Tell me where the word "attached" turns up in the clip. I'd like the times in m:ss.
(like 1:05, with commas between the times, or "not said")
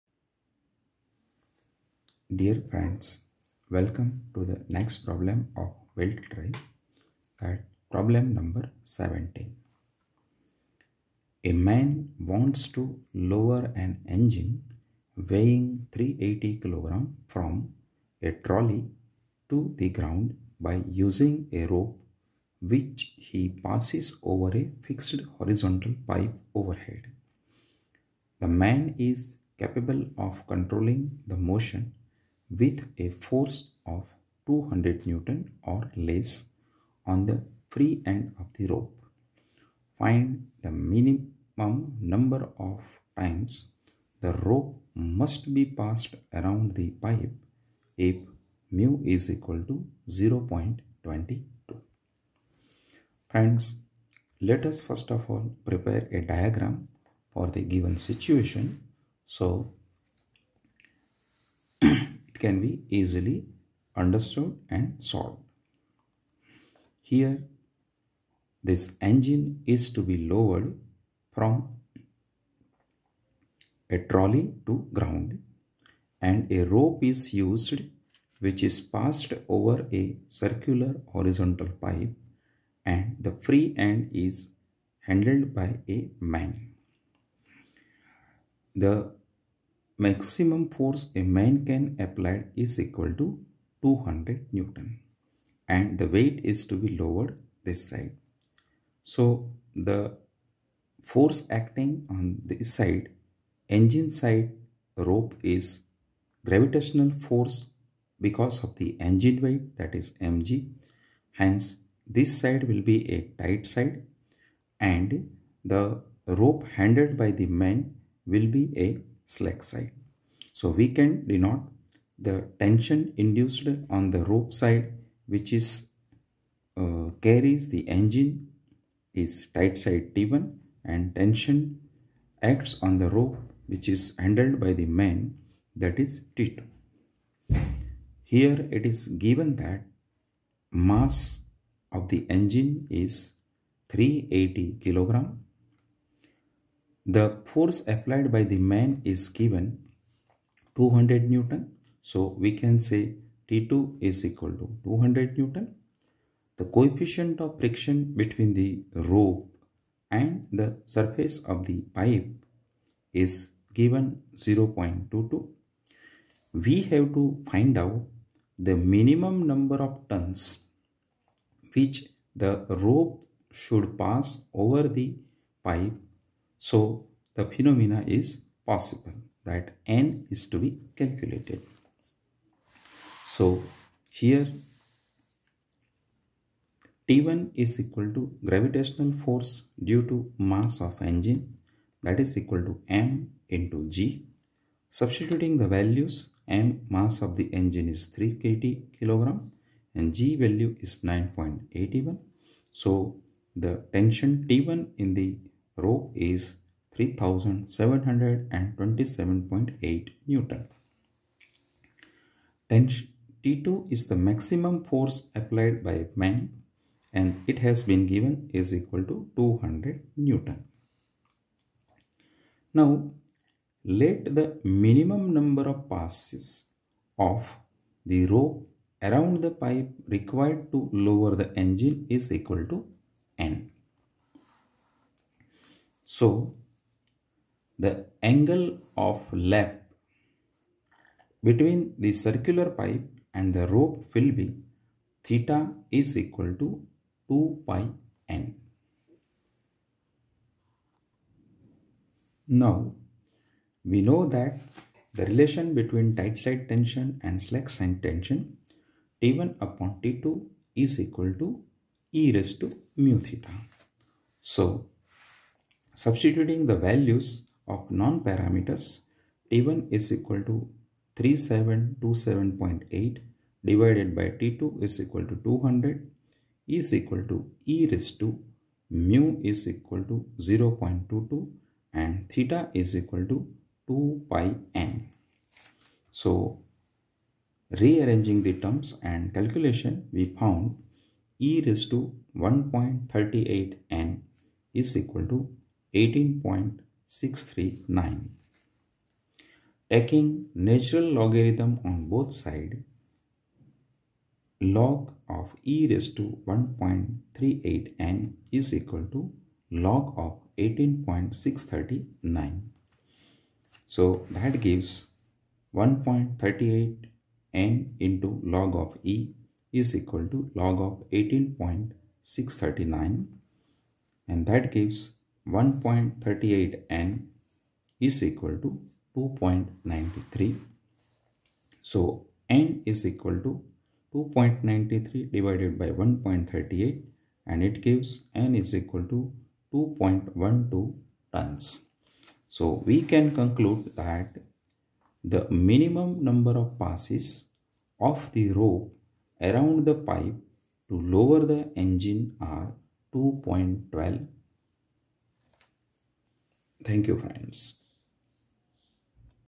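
not said.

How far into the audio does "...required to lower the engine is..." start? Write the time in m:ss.
3:50.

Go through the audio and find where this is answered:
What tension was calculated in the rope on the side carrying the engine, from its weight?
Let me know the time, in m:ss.
3:26.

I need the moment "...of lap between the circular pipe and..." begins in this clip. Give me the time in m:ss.
3:58.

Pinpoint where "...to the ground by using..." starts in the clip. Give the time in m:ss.
0:19.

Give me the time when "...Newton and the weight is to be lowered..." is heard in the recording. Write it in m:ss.
1:34.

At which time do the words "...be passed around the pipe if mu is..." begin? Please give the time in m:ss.
0:45.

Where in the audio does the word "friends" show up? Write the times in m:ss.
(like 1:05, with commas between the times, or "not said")
0:02, 0:53, 5:57.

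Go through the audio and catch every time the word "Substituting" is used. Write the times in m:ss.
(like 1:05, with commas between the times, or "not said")
3:14, 4:26.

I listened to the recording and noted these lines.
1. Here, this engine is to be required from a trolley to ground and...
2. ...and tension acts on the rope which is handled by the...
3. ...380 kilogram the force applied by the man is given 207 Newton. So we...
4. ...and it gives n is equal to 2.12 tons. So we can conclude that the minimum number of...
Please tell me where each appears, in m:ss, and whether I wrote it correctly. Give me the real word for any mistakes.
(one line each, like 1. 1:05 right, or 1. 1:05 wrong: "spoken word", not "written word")
1. 1:07 wrong: "lowered", not "required"
2. 2:10 right
3. 2:23 wrong: "200", not "207"
4. 5:37 right.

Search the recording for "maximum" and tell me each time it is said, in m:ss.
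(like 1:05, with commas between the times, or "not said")
1:30, 3:34.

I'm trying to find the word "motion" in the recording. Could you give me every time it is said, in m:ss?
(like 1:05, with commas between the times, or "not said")
0:31.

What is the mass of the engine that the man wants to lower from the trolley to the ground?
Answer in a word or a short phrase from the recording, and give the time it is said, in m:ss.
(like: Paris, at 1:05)
380 kg, at 0:15.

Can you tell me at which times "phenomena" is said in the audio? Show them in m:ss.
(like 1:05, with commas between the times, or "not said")
2:57.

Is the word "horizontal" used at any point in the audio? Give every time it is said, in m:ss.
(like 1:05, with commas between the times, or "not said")
0:25, 1:21.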